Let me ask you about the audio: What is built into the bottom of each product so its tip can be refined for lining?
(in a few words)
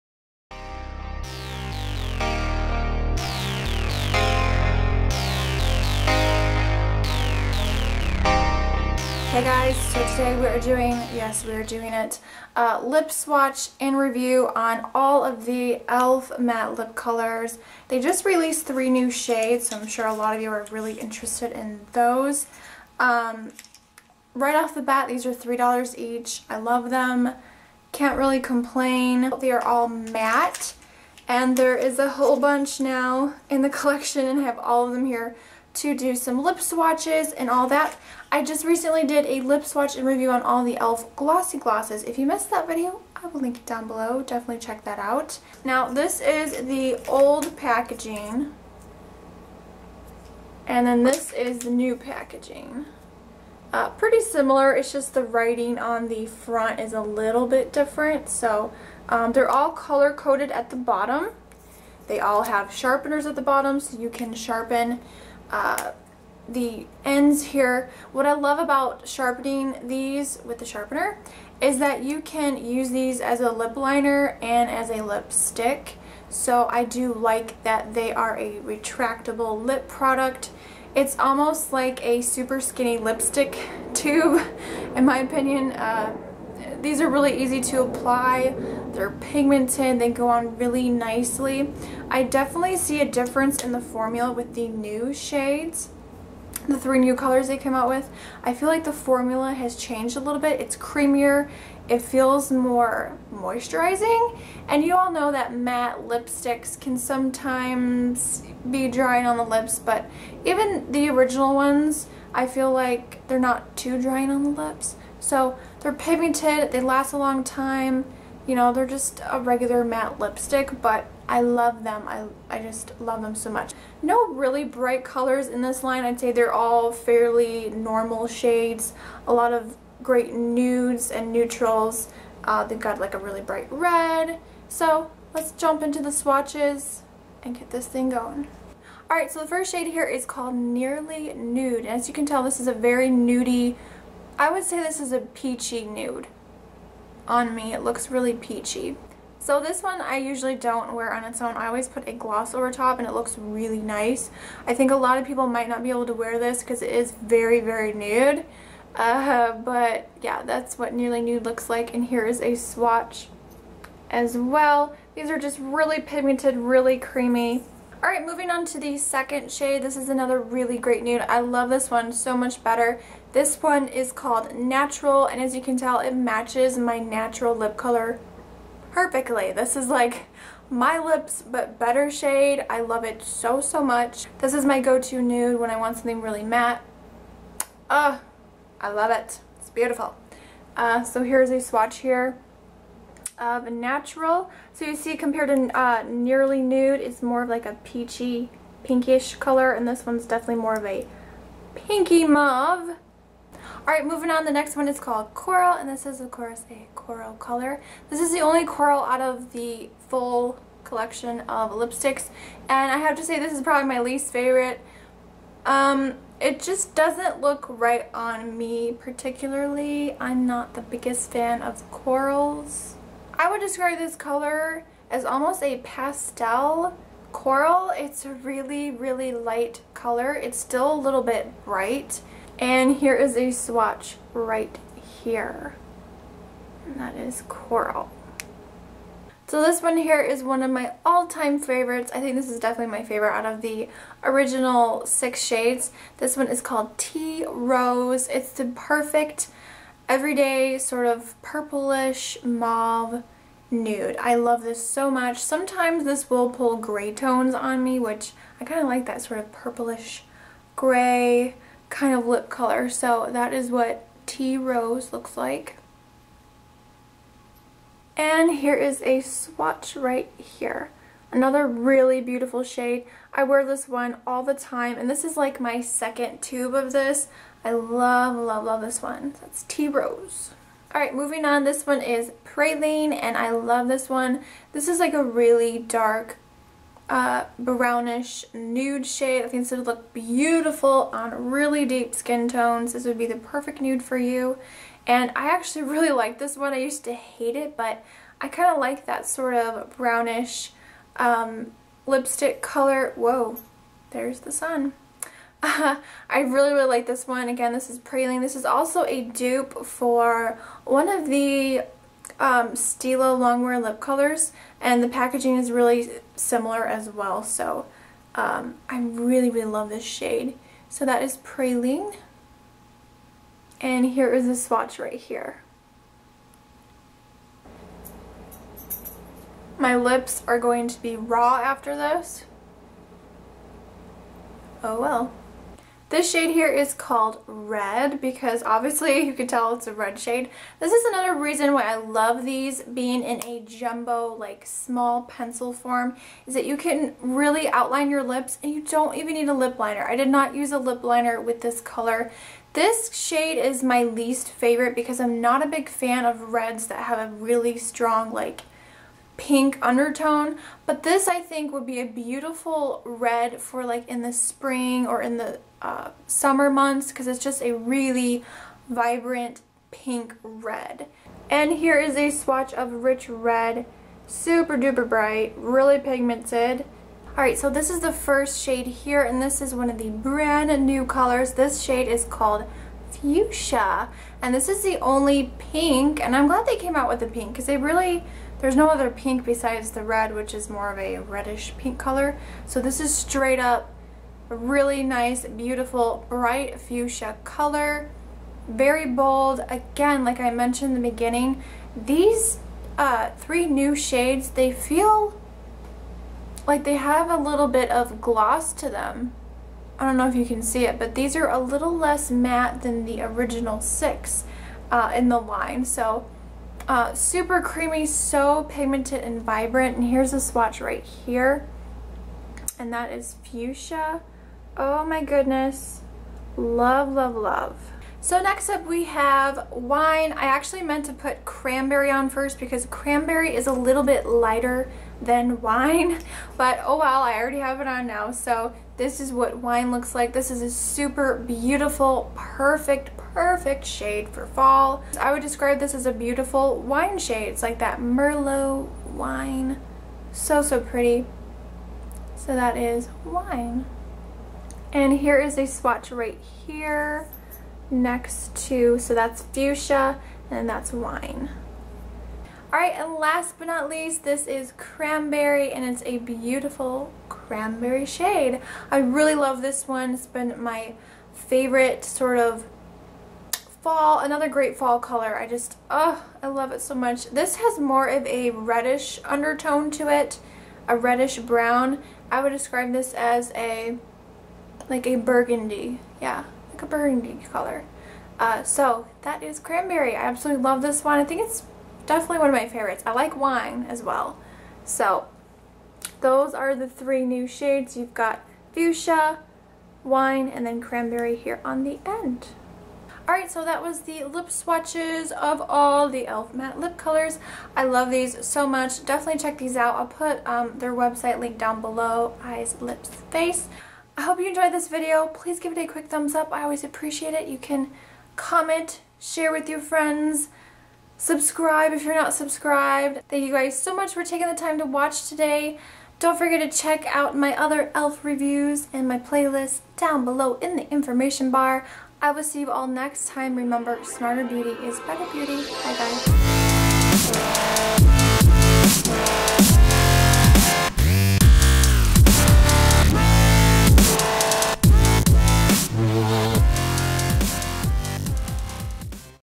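sharpeners.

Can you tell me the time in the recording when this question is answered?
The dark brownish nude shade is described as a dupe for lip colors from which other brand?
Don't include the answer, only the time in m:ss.
5:12.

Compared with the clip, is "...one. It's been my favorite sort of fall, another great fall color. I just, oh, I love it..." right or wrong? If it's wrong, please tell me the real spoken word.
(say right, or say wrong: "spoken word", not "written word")
right.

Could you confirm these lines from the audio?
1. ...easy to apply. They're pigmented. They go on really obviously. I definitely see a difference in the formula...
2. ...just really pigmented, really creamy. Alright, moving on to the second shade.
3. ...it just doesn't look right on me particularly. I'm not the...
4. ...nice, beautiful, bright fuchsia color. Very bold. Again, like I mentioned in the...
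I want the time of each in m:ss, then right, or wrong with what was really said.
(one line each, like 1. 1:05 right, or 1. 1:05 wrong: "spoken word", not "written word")
1. 1:27 wrong: "nicely", not "obviously"
2. 2:45 right
3. 3:36 right
4. 6:35 right.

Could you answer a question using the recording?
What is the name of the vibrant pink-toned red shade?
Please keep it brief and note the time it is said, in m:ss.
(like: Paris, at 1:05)
Rich Red, at 6:13.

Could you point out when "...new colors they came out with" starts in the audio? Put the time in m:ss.
1:36.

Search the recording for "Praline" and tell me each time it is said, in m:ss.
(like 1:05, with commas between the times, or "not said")
4:42, 5:07, 5:21.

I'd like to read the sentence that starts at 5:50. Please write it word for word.
I did not use a lip liner with this color.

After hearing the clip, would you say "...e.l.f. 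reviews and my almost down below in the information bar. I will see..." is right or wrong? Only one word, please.
wrong.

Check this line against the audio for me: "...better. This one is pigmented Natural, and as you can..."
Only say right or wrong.
wrong.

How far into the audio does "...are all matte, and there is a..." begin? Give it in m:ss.
0:29.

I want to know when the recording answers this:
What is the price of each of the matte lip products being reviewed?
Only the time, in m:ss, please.
0:25.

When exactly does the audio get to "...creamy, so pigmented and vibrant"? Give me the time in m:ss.
6:57.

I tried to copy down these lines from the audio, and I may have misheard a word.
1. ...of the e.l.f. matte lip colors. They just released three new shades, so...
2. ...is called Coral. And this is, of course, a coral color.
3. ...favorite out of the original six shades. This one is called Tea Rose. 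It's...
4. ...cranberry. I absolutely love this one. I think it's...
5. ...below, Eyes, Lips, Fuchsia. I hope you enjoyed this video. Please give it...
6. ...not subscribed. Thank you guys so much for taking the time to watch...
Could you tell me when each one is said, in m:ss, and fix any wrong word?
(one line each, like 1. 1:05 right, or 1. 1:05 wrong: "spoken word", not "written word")
1. 0:15 right
2. 3:24 right
3. 4:03 right
4. 8:09 right
5. 8:31 wrong: "Face", not "Fuchsia"
6. 8:42 right.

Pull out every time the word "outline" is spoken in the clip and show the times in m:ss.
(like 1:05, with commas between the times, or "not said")
5:47.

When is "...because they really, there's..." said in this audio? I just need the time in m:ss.
6:27.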